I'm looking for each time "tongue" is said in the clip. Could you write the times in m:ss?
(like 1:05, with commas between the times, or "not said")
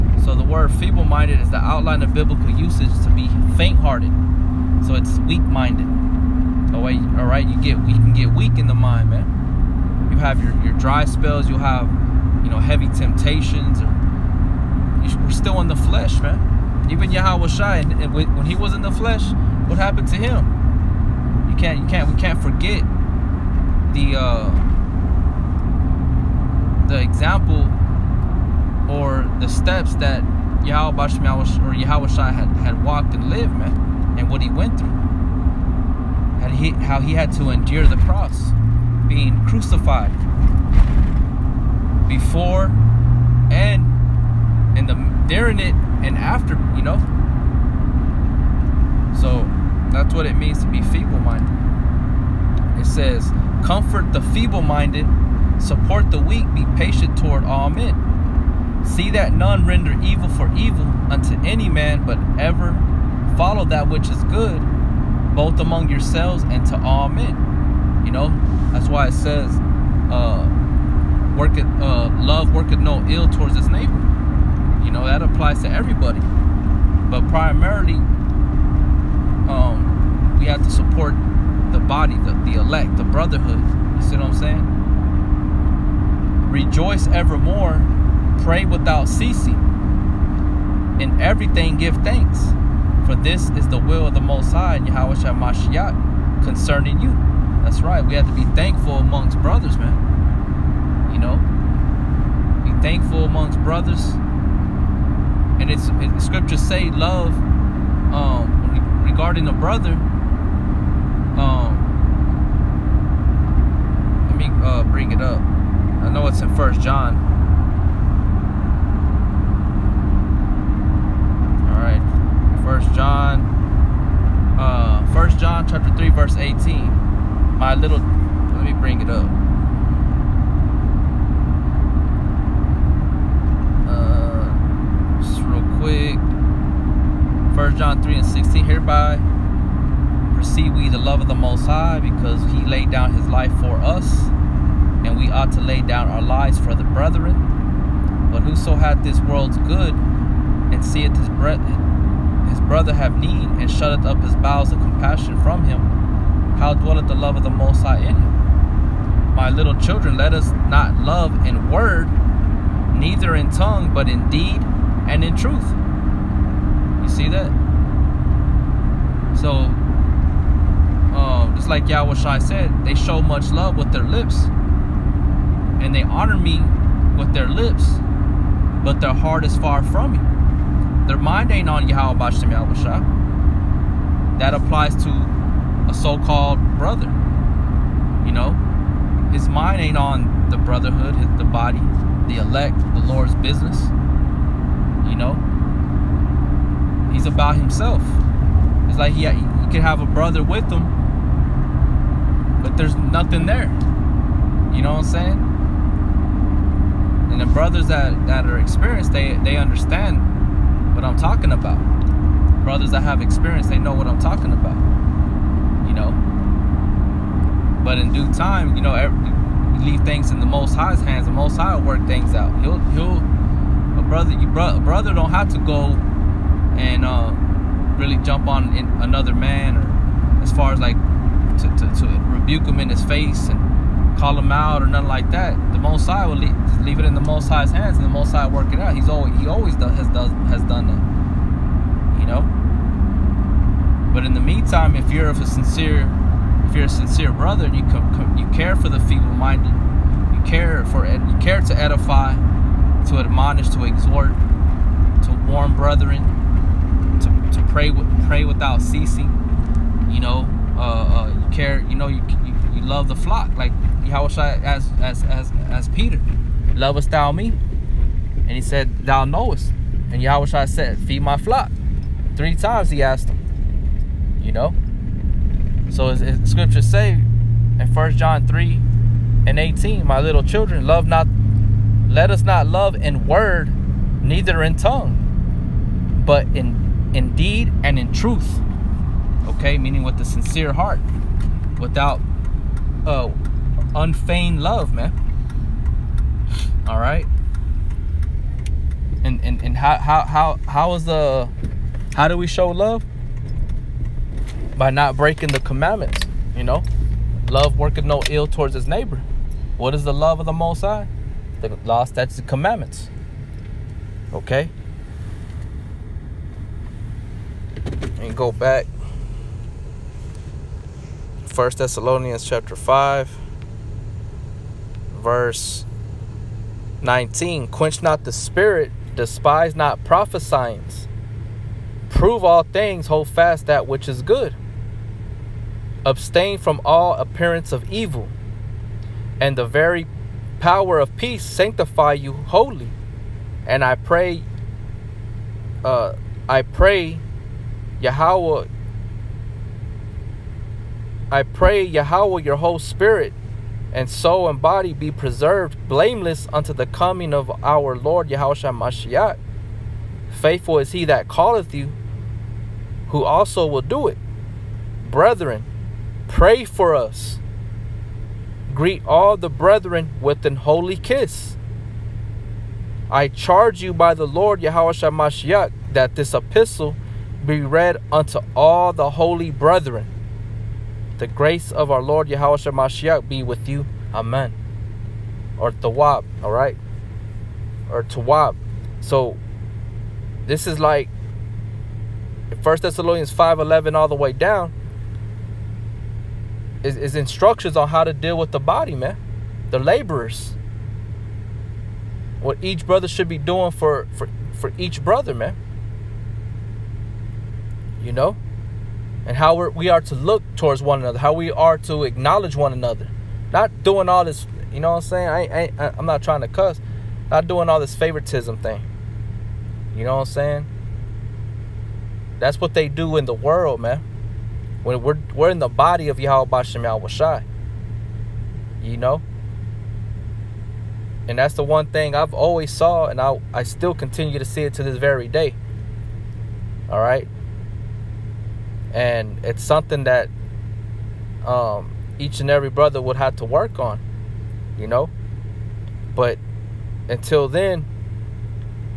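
2:43, 4:44.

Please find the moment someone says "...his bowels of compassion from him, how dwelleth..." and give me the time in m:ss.
2:34.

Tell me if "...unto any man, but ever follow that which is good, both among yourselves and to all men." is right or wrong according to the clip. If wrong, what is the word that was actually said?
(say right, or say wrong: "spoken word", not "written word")
right.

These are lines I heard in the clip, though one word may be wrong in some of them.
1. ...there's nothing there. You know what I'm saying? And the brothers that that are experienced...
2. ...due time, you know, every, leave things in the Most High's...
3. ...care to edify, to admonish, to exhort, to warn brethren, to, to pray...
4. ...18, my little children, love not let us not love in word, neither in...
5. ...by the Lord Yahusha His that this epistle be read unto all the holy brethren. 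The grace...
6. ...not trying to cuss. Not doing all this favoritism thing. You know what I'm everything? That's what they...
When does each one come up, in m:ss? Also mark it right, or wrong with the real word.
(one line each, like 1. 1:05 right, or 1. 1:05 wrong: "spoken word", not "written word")
1. 3:22 right
2. 3:38 right
3. 4:11 right
4. 4:39 right
5. 6:13 wrong: "Mashiach", not "His"
6. 6:56 wrong: "saying", not "everything".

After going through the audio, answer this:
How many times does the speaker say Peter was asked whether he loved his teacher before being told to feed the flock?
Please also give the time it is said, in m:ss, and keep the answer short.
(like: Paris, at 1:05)
3, at 4:32.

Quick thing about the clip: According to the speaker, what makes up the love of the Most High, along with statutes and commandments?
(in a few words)
The law.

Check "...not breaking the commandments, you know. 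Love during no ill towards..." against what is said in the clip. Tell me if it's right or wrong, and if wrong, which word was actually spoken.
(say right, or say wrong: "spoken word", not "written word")
wrong: "working", not "during".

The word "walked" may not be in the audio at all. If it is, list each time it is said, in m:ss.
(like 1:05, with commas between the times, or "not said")
0:32.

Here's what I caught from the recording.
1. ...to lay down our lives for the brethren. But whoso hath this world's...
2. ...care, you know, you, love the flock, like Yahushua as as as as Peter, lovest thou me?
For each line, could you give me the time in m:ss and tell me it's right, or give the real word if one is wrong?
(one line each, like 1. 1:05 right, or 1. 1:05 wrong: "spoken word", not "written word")
1. 2:25 right
2. 4:21 right.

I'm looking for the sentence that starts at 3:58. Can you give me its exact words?
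He's always he always does, has does has done that, you know.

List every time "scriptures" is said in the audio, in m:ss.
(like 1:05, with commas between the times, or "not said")
1:46, 4:36.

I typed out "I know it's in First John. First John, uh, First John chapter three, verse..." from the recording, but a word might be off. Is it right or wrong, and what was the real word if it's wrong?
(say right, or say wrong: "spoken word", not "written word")
right.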